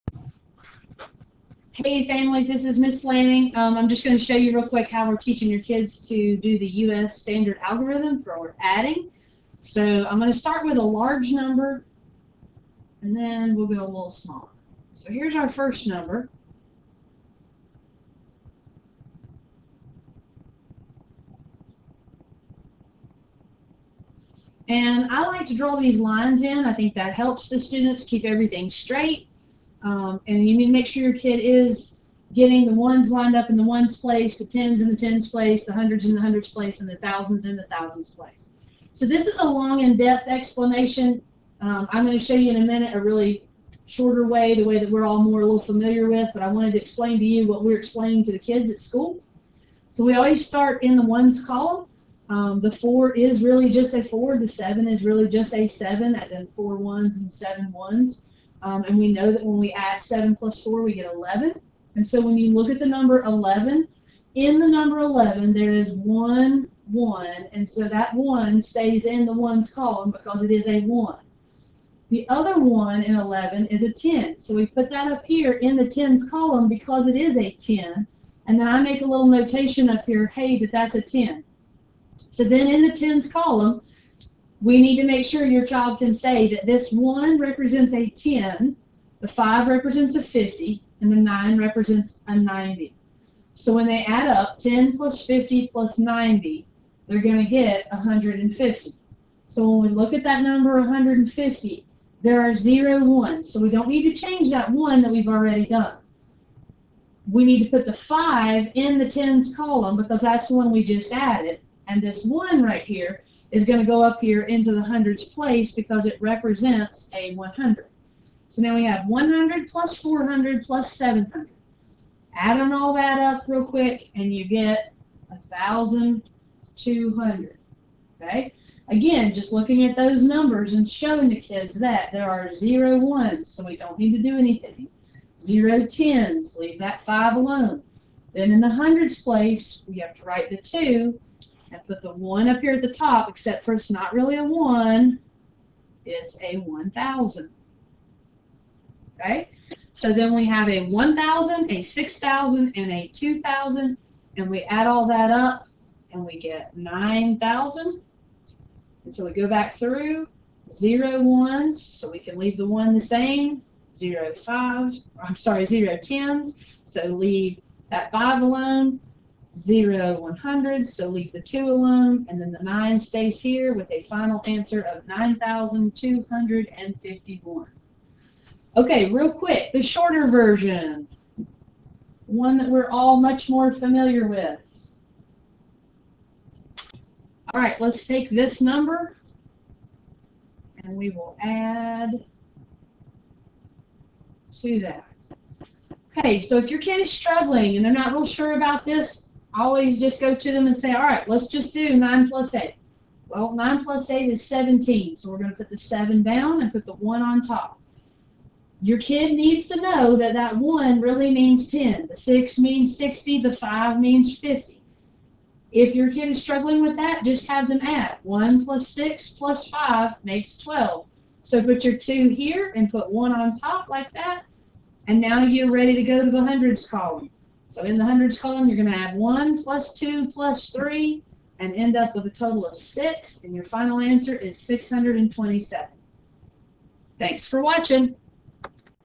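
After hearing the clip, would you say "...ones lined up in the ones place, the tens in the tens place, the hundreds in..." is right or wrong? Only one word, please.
right.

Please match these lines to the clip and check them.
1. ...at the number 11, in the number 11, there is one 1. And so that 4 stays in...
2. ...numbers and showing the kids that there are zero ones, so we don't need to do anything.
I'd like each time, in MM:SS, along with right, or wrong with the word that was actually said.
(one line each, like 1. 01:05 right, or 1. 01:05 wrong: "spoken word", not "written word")
1. 01:02 wrong: "1", not "4"
2. 02:10 right.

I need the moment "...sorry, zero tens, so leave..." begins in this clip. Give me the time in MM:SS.
02:45.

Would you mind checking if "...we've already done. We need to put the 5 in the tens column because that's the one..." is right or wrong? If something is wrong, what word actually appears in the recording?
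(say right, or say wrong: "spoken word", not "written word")
right.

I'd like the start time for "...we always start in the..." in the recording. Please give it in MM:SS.
00:50.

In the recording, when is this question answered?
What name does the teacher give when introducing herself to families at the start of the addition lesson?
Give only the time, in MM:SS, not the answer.
00:02.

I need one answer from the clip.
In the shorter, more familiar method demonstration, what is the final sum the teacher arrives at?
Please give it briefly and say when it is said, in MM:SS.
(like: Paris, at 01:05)
627, at 03:54.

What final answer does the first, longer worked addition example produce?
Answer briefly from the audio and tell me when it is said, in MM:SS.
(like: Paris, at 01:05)
9,251, at 02:55.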